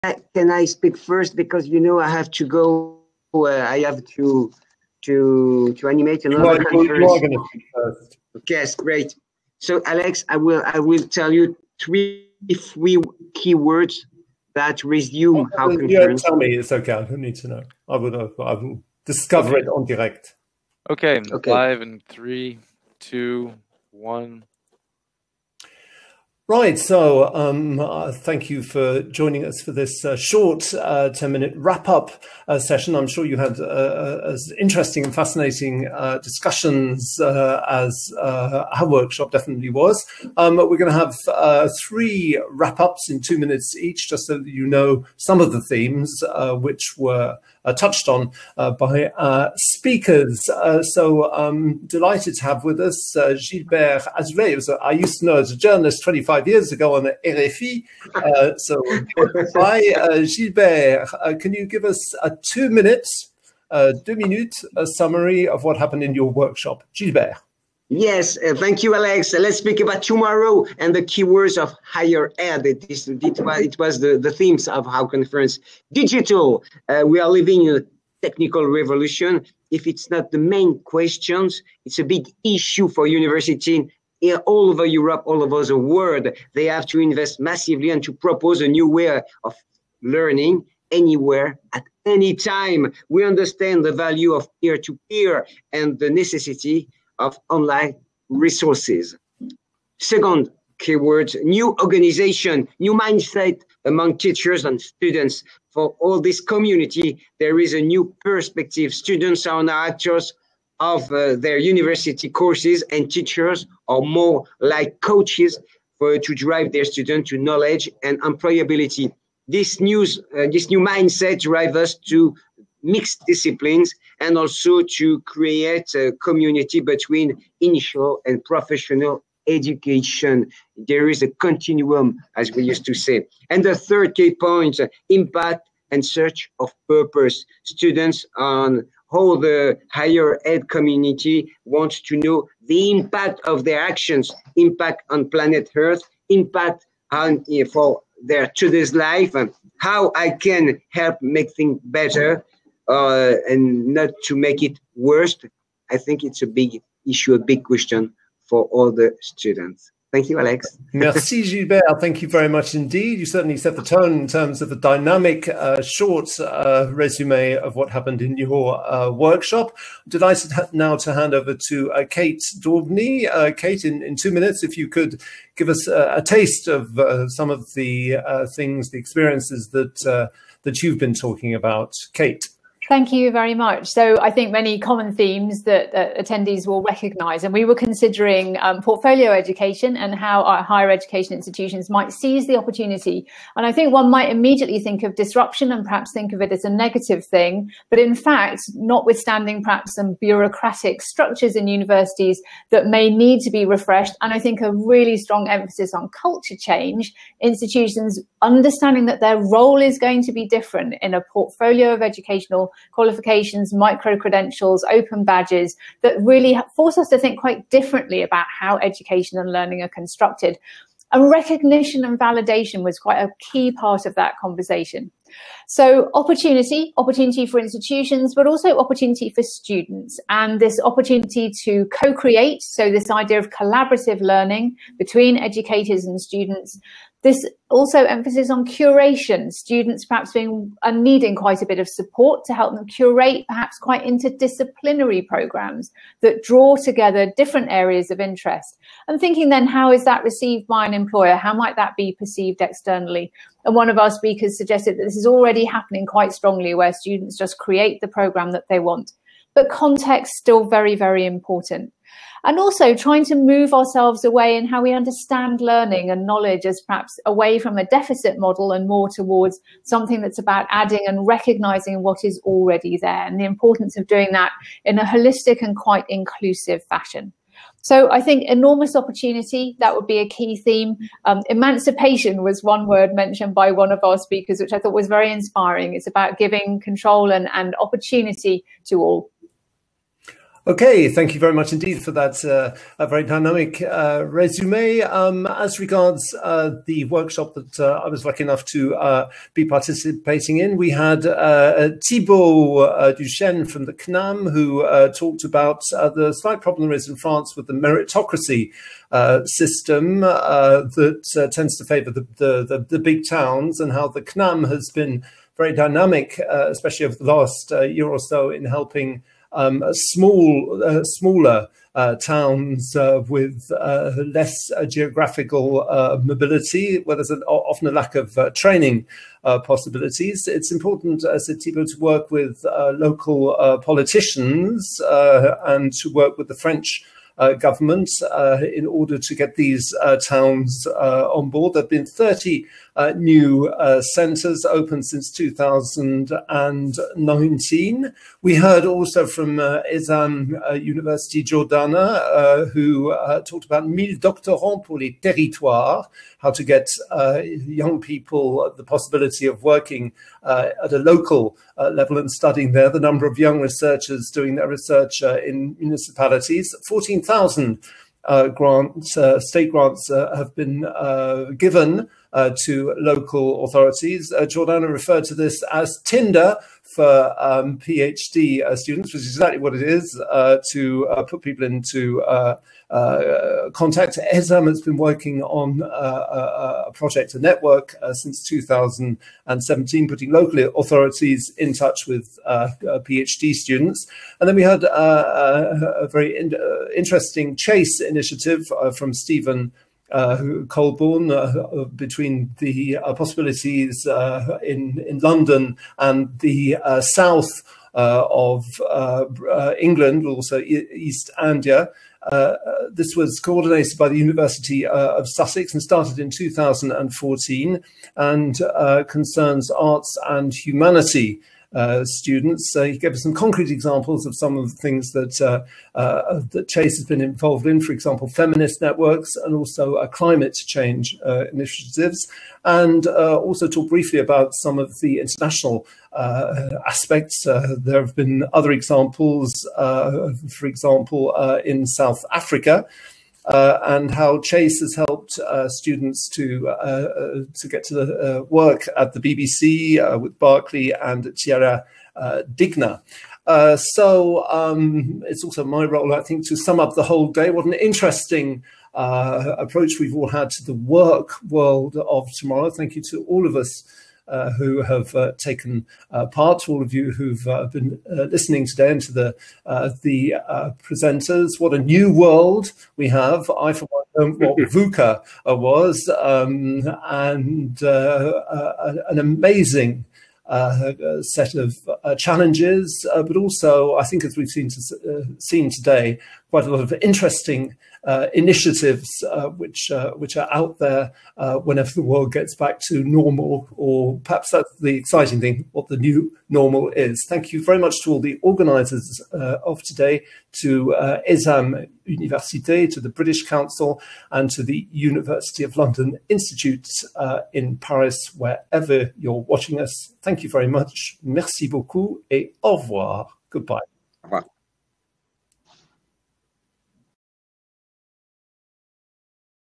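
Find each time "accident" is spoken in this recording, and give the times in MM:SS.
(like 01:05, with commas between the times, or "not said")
not said.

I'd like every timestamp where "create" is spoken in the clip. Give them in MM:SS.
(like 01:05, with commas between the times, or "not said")
02:05, 03:51, 04:17.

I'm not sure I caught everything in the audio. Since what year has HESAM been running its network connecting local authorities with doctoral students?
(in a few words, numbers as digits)
2017.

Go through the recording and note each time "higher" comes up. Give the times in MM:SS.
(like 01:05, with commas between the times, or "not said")
01:11, 02:19, 03:10.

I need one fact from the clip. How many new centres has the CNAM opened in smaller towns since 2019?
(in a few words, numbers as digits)
30.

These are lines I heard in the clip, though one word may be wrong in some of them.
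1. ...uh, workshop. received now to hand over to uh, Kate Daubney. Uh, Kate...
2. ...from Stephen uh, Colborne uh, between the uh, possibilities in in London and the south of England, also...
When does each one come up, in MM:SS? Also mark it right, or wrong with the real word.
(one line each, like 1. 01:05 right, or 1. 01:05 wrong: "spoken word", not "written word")
1. 02:48 wrong: "delighted", not "received"
2. 06:38 right.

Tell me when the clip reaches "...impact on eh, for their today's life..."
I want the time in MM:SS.
02:26.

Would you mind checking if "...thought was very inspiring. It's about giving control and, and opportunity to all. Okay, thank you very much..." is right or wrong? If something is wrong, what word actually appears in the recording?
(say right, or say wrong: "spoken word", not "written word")
right.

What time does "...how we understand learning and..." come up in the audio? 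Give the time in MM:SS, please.
04:24.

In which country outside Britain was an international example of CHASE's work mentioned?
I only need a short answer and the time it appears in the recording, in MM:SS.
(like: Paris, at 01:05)
South Africa, at 07:21.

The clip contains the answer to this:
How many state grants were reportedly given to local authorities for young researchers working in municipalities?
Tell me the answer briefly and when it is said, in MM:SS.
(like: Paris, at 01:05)
14,000, at 06:06.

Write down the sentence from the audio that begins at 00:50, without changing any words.
Uh, so um, delighted to have with us Gilbert Azoulay, I used to know as a journalist 25 years ago on RFI.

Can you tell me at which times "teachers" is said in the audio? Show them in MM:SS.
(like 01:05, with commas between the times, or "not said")
01:44, 01:53.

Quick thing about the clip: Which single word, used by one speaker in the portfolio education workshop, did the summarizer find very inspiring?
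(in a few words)
Emancipation.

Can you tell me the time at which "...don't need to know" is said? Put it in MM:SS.
00:17.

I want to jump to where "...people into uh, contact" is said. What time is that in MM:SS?
06:21.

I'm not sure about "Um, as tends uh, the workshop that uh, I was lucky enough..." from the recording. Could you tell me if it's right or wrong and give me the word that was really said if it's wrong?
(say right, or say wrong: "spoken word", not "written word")
wrong: "regards", not "tends".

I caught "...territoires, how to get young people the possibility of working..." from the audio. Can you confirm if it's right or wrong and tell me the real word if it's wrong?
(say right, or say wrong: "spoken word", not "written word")
right.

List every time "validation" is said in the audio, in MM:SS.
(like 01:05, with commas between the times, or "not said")
03:42.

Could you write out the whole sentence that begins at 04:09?
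And thinking then, how is that received by an employer?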